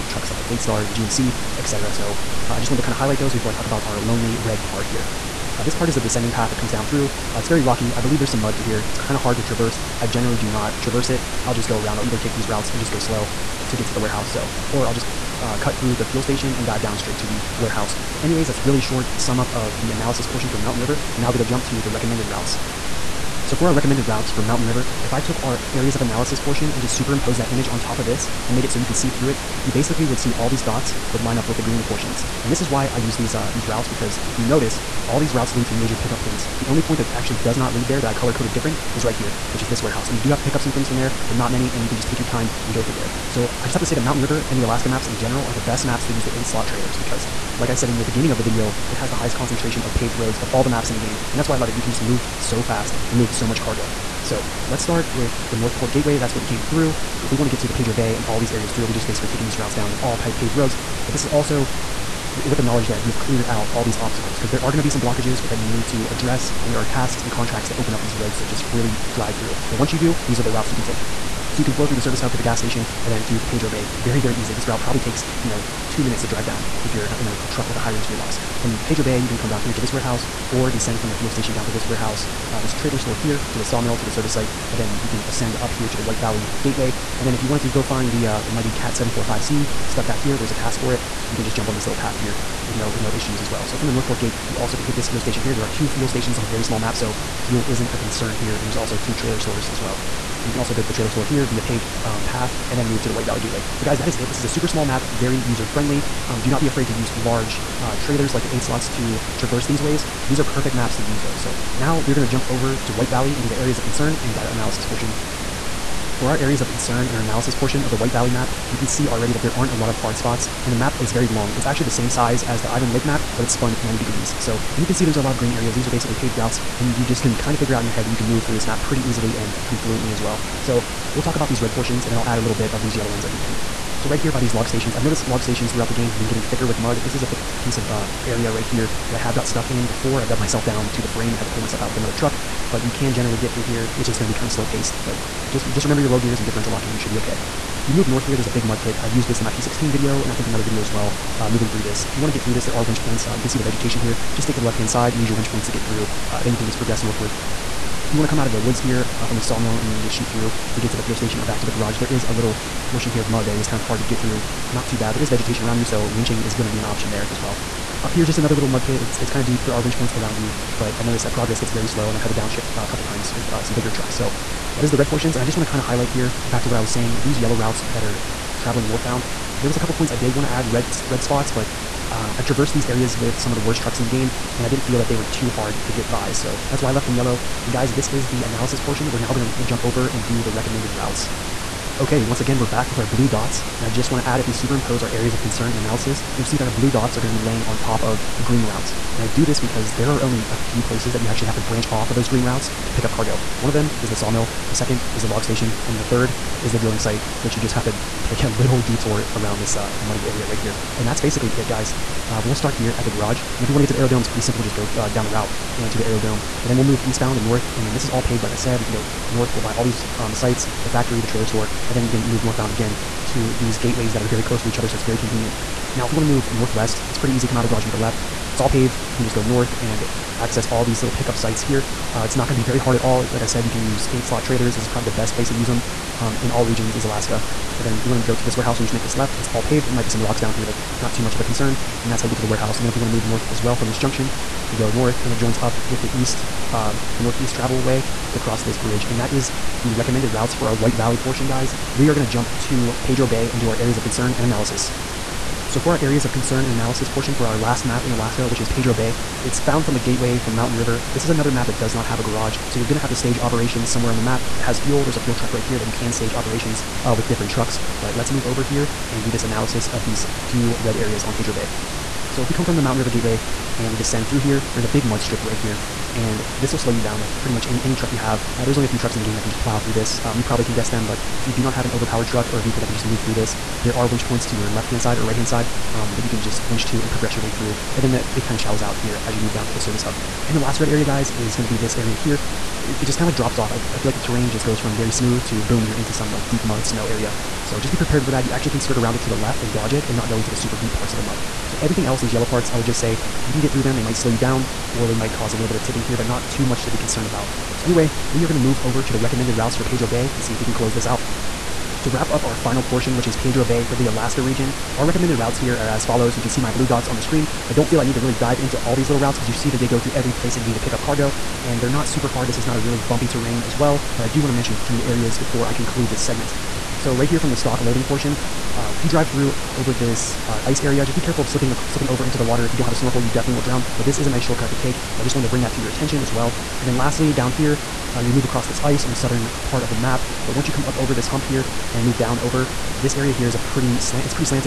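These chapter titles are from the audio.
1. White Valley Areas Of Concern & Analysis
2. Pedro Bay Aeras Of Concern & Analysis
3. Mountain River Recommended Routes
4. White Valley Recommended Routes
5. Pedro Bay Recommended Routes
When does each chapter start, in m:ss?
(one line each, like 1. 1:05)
1. 1:50
2. 4:11
3. 0:20
4. 3:07
5. 5:07.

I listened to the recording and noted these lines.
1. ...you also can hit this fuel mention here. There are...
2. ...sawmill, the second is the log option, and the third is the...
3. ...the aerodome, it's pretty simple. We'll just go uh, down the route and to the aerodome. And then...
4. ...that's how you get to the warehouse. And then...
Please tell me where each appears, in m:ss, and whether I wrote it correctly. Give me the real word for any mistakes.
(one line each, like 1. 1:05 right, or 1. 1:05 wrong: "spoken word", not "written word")
1. 1:34 wrong: "station", not "mention"
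2. 3:24 wrong: "station", not "option"
3. 3:33 right
4. 4:02 right.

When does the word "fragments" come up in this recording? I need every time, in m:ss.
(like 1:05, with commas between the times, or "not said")
not said.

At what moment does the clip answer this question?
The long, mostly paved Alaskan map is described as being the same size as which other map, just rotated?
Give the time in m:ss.
2:02.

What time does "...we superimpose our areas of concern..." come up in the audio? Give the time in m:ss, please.
3:14.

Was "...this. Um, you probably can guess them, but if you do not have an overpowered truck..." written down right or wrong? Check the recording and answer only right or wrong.
right.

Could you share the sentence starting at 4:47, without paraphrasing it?
And then the, it kind of shallows out here as you move down to the service hub.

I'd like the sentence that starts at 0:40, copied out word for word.
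And you do have to pick up some things from there, but not many.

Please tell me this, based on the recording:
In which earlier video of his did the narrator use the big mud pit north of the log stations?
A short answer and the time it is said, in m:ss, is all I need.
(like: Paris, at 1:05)
P16 video, at 2:29.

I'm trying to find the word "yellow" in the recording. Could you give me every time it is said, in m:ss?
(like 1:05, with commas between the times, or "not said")
2:12, 2:57, 3:07, 5:02.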